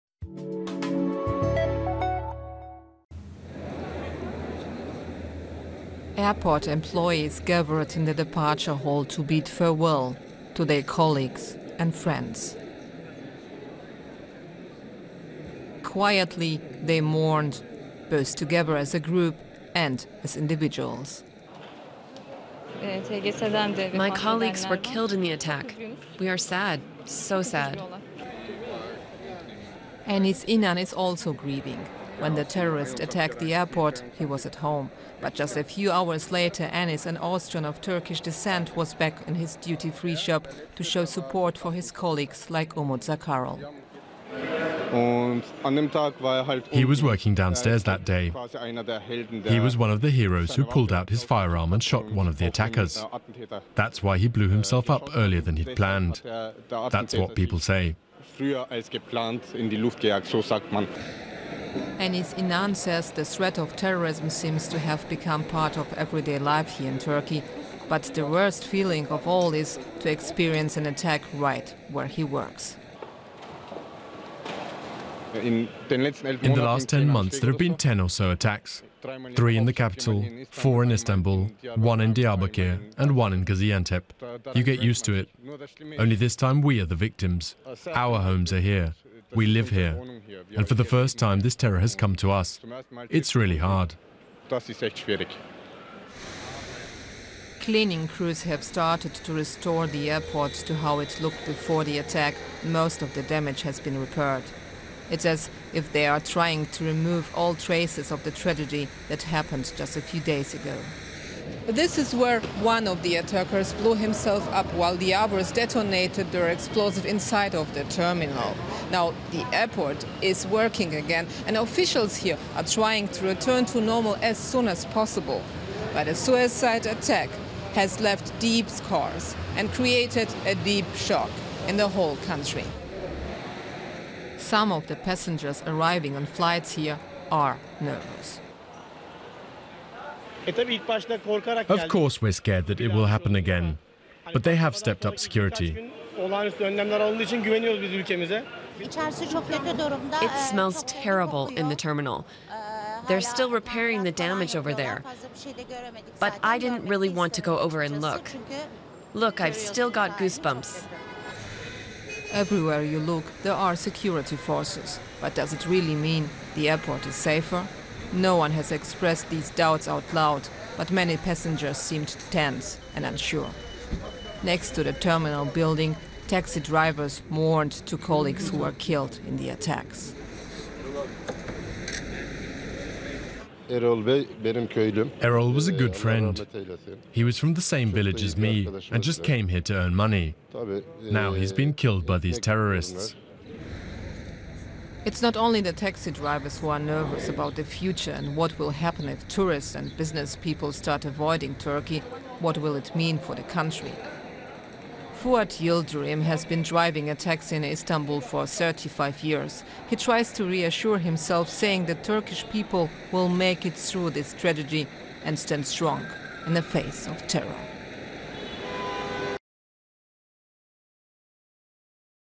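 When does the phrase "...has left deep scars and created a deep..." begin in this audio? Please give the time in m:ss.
2:07.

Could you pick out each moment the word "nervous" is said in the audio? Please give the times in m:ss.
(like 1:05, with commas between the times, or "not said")
2:17, 3:16.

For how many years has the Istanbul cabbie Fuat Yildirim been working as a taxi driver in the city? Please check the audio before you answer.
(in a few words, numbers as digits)
35.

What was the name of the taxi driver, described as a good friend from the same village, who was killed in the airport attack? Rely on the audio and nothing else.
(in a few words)
Errol.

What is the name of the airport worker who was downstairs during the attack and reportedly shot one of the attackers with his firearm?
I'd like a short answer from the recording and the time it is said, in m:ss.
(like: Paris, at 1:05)
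Umut Zakarol, at 0:42.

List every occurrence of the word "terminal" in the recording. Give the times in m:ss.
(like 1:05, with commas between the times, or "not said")
1:57, 2:31, 2:54.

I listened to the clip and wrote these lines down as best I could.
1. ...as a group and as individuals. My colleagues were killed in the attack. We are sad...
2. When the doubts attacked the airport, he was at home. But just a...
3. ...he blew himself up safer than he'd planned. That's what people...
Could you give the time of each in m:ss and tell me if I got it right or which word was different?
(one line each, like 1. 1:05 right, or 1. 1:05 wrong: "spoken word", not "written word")
1. 0:18 right
2. 0:32 wrong: "terrorists", not "doubts"
3. 0:54 wrong: "earlier", not "safer".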